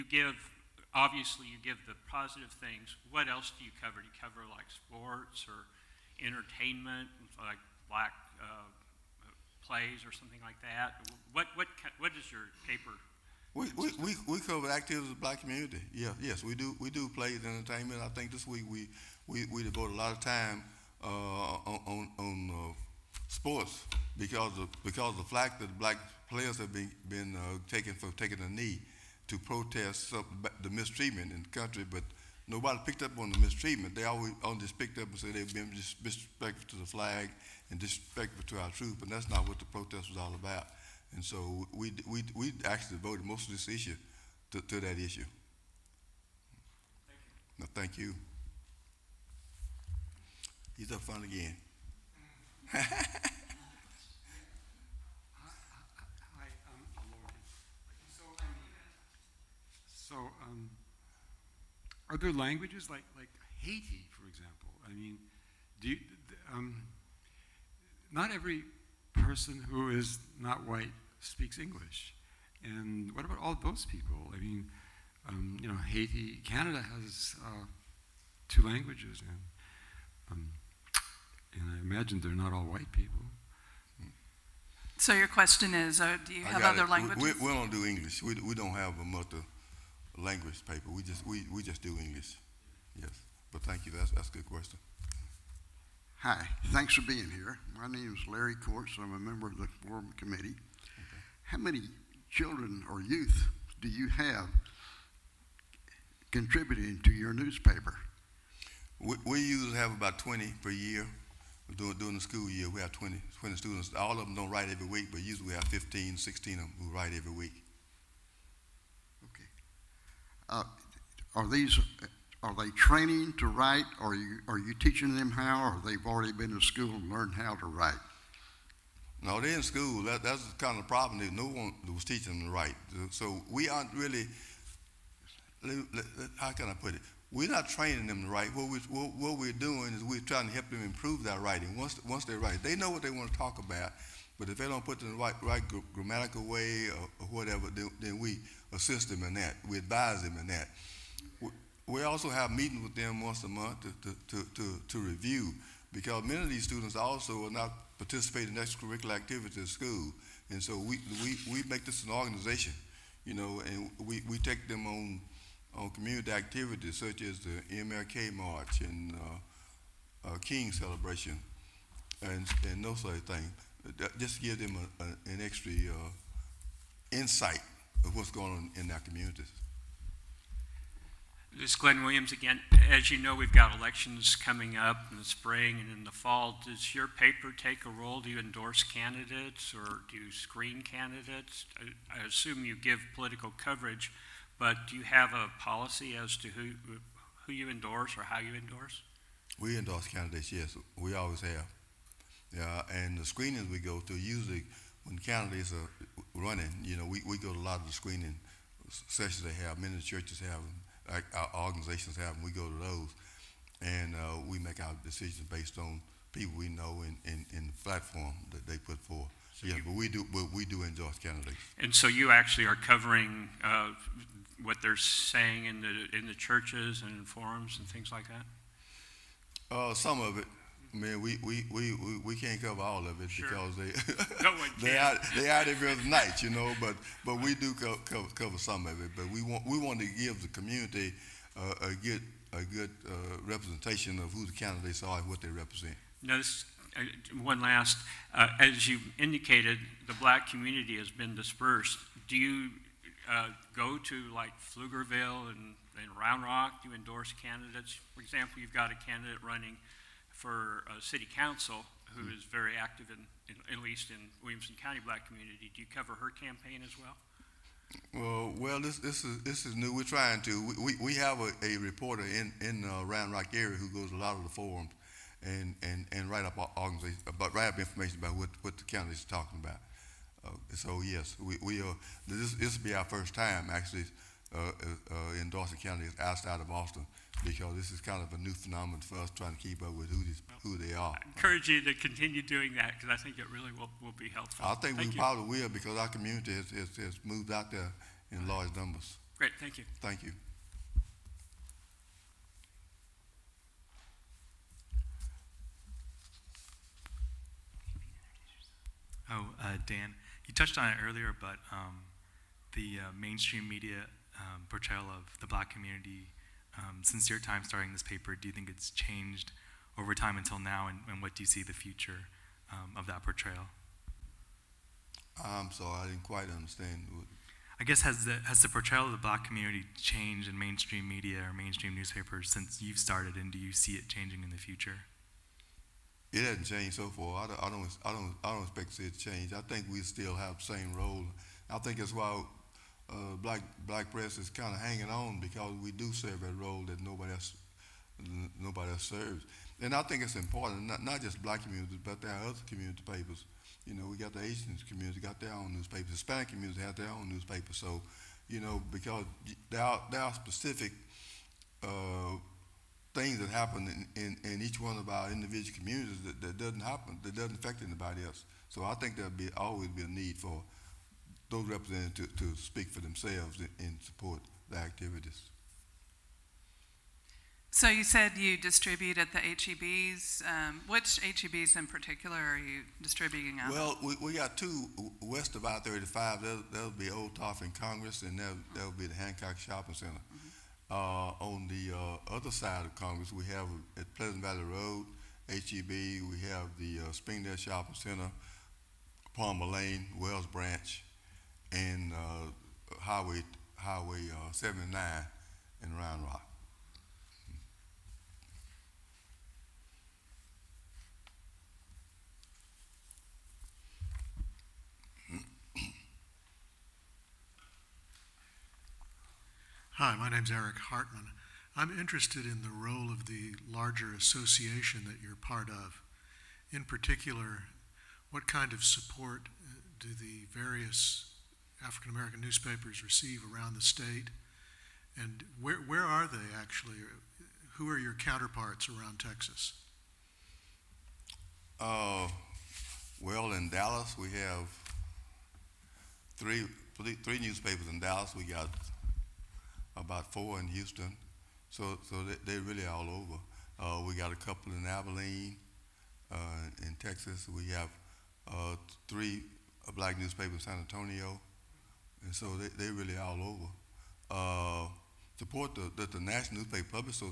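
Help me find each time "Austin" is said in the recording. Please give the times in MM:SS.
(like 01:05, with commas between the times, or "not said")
04:46.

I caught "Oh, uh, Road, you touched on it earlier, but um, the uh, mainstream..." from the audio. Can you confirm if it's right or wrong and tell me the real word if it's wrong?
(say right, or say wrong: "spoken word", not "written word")
wrong: "Dan", not "Road".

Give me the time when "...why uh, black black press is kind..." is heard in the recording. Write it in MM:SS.
05:42.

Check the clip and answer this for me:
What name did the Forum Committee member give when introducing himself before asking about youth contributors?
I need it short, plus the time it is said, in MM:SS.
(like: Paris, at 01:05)
Larry Courts, at 01:38.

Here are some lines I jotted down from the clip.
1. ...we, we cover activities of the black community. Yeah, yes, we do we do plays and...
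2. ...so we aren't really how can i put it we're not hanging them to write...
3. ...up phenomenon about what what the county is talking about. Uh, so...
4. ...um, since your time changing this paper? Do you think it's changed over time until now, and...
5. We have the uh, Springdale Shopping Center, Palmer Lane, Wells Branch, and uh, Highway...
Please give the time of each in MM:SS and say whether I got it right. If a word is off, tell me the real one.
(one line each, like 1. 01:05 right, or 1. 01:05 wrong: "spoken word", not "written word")
1. 00:14 right
2. 02:13 wrong: "training", not "hanging"
3. 04:37 wrong: "information", not "phenomenon"
4. 05:16 wrong: "starting", not "changing"
5. 06:36 right.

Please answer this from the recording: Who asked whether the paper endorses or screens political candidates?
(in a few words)
Glenn Williams.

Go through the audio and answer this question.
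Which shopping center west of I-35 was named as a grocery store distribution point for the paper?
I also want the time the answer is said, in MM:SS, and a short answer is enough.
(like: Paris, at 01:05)
Hancock Shopping Center, at 06:29.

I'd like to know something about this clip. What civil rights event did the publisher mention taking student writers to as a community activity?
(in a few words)
MLK March.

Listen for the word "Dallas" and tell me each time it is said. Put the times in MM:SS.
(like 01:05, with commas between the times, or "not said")
07:23, 07:27.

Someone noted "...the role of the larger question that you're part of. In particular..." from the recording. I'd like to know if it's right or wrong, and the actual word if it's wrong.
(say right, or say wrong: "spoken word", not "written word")
wrong: "association", not "question".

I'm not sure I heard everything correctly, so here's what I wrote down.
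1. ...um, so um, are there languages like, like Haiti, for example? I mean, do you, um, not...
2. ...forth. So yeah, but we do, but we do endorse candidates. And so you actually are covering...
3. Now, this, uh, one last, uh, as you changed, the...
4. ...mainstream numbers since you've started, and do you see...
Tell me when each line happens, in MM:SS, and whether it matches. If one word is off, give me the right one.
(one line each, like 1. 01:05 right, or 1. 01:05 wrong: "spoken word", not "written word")
1. 00:58 right
2. 03:38 right
3. 04:06 wrong: "indicated", not "changed"
4. 05:31 wrong: "newspapers", not "numbers".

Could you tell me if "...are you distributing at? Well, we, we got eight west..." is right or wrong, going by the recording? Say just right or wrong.
wrong.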